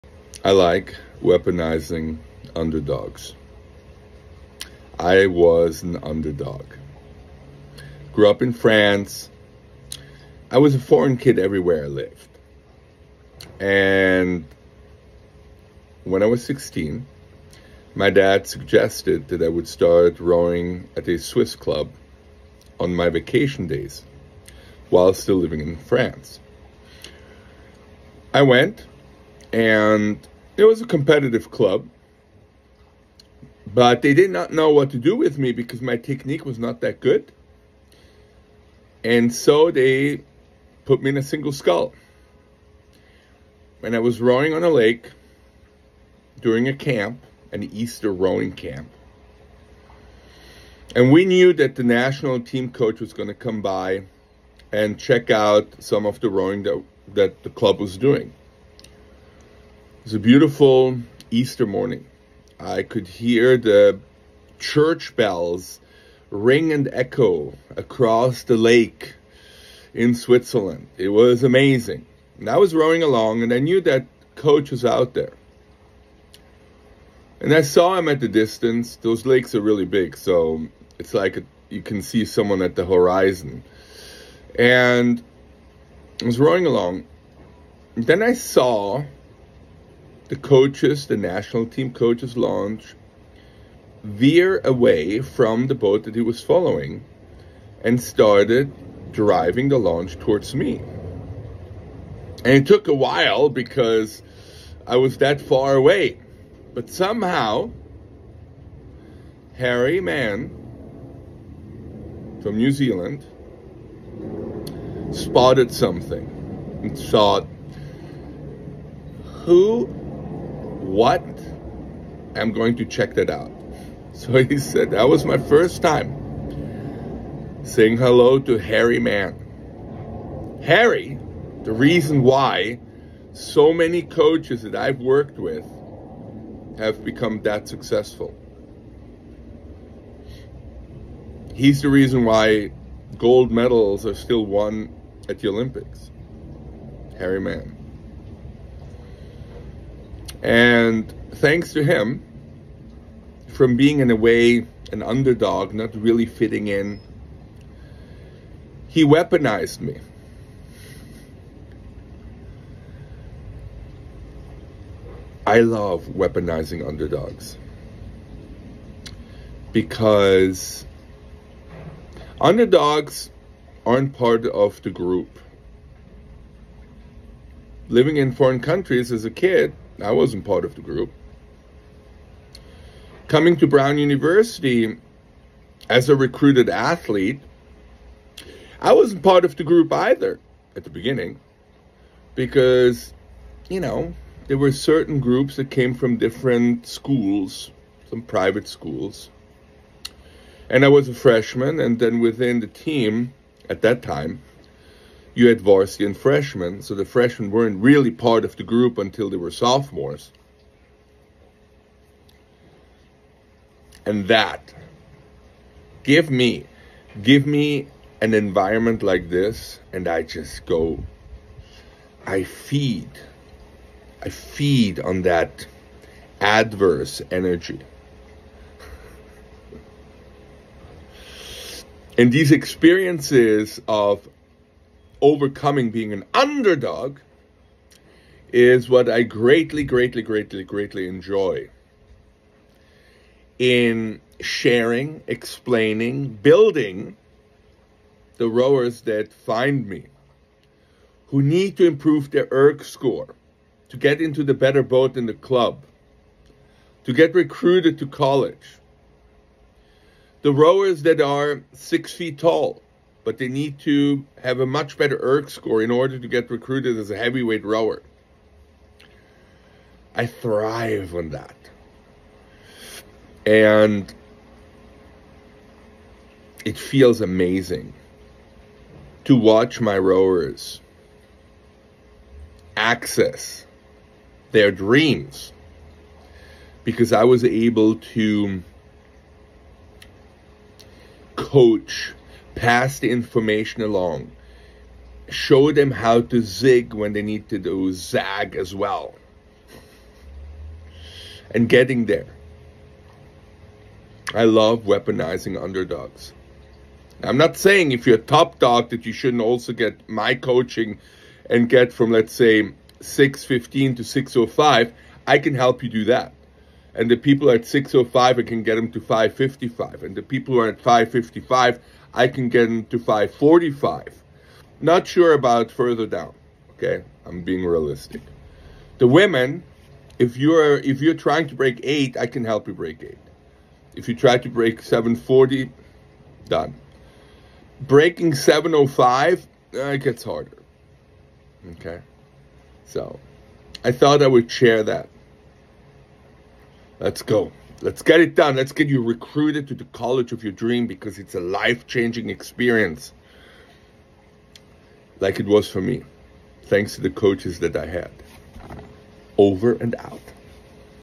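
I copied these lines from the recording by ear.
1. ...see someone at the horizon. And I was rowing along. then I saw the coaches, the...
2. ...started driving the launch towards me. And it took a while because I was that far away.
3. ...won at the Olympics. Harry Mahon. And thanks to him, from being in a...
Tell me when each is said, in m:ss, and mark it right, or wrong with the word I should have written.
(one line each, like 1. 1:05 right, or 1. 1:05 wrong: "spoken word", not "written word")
1. 1:22 right
2. 1:38 right
3. 2:24 right.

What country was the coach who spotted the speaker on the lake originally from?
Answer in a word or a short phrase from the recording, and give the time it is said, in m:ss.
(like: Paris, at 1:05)
New Zealand, at 1:52.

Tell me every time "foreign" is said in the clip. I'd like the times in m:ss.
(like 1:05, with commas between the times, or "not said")
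0:10, 2:58.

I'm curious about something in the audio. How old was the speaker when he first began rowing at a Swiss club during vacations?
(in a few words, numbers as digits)
16.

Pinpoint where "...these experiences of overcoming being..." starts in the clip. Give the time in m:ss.
3:52.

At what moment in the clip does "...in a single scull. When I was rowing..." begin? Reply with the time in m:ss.
0:41.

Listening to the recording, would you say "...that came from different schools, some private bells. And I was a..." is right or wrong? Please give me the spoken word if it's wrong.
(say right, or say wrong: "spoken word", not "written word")
wrong: "schools", not "bells".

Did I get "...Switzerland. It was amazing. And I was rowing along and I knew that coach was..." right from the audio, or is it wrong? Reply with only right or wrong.
right.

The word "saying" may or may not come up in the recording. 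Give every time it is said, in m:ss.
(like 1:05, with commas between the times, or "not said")
2:07, 5:07.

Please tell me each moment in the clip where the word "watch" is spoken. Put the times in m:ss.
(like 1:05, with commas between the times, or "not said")
4:39.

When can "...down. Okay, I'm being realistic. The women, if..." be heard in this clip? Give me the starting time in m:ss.
5:26.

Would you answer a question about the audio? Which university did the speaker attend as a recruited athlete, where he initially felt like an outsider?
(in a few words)
Brown University.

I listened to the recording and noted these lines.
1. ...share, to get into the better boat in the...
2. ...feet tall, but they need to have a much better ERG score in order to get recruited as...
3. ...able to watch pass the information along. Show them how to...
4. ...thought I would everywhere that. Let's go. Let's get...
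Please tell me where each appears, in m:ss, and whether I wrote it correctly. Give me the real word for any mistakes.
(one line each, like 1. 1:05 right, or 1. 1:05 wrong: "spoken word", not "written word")
1. 4:12 wrong: "score", not "share"
2. 4:22 right
3. 4:47 wrong: "coach", not "watch"
4. 5:43 wrong: "share", not "everywhere".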